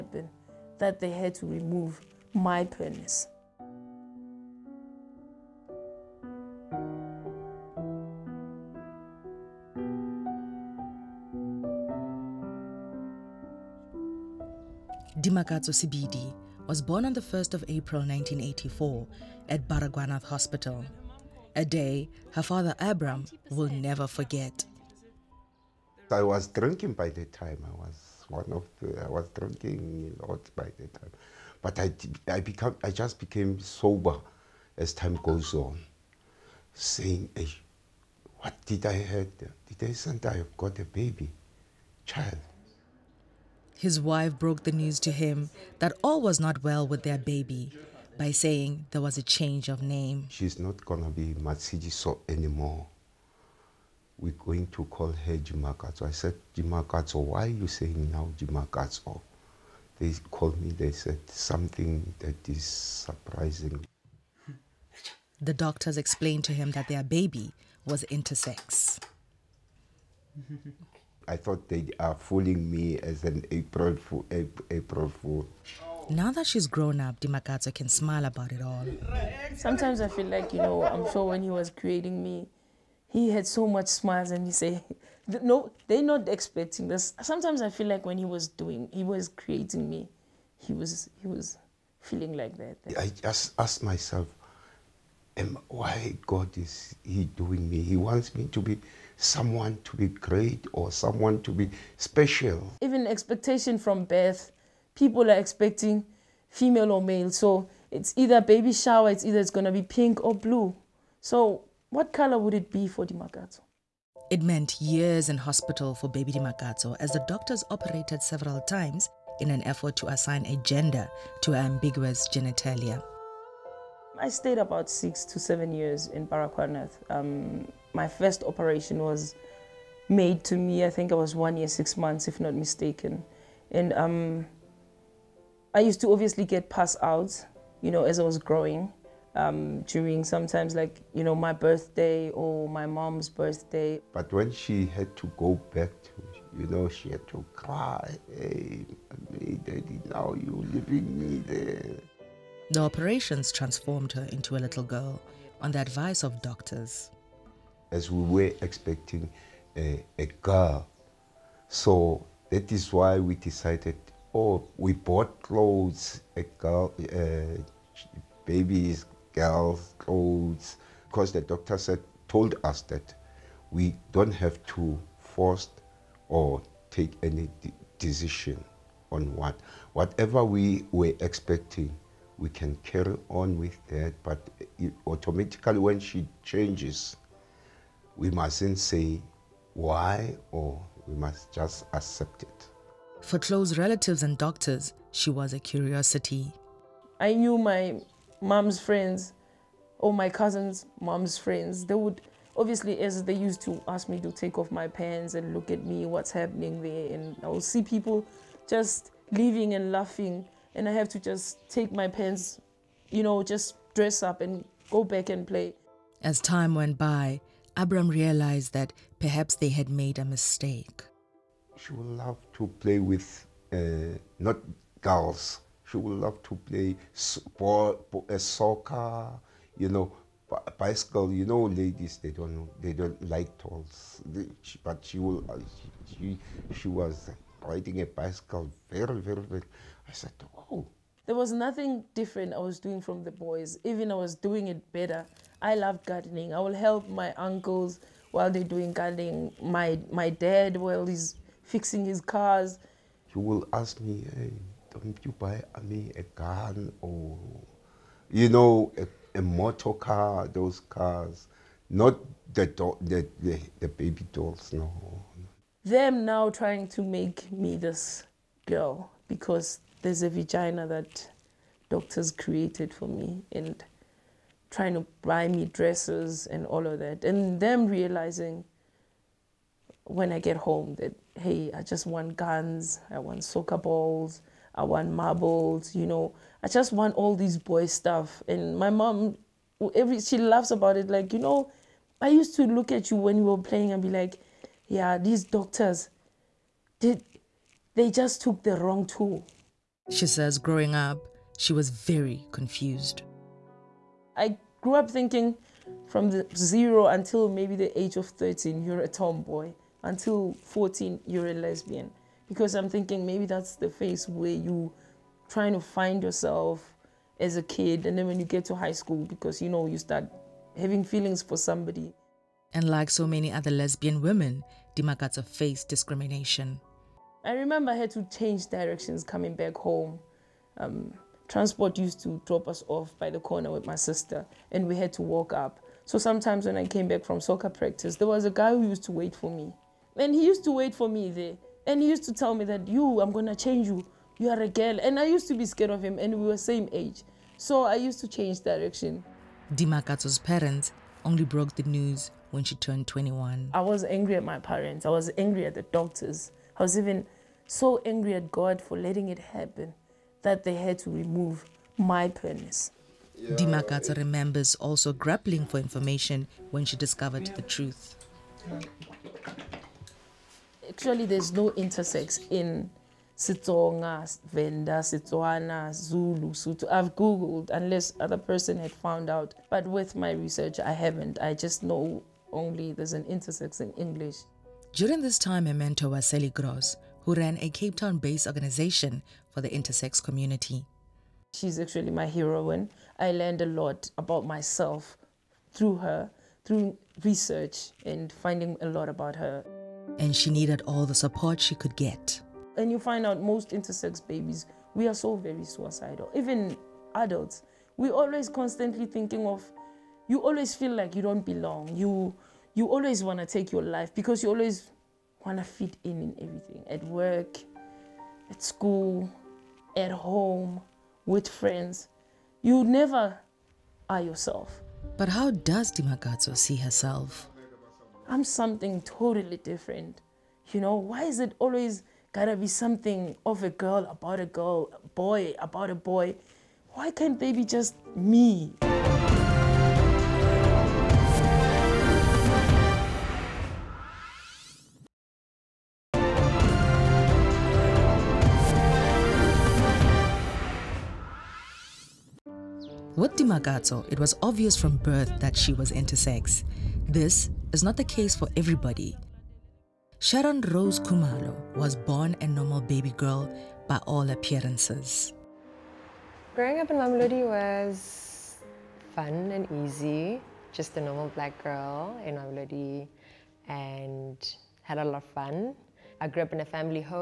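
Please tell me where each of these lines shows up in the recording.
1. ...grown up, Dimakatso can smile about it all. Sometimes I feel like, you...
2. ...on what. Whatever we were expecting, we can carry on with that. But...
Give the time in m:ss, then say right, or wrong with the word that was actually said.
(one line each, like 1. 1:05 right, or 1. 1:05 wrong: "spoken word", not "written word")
1. 1:16 right
2. 2:59 right.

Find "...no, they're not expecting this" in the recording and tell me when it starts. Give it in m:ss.
1:25.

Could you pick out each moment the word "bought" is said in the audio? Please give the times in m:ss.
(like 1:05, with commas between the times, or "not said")
2:44.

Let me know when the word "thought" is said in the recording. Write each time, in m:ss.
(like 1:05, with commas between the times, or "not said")
1:11.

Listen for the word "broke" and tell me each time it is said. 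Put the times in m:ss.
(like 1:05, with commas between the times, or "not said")
0:44, 5:51.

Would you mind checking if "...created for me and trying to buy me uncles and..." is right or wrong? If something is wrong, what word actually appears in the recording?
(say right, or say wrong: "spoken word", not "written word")
wrong: "dresses", not "uncles".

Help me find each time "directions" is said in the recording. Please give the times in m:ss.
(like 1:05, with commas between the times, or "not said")
5:28, 5:48.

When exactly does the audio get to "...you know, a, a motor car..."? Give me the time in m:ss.
4:18.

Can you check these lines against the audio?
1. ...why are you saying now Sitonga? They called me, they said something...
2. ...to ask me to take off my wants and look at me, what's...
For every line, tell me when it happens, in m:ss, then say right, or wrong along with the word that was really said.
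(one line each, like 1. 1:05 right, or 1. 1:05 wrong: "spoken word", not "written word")
1. 0:57 wrong: "Dimakatso", not "Sitonga"
2. 3:23 wrong: "pants", not "wants".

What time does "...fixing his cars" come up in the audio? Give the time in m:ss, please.
4:11.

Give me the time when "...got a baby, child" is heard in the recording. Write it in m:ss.
0:40.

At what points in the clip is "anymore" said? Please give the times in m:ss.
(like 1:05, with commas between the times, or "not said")
0:52.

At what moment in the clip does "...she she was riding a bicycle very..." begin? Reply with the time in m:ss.
3:56.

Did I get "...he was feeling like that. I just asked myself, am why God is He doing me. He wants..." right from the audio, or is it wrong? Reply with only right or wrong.
right.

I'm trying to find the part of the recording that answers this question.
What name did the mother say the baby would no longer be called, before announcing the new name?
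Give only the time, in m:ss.
0:51.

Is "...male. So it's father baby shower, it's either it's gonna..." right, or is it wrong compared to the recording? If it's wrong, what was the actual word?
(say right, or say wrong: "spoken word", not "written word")
wrong: "either", not "father".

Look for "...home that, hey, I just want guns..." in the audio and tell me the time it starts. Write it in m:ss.
4:40.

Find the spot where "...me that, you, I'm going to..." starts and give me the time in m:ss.
5:42.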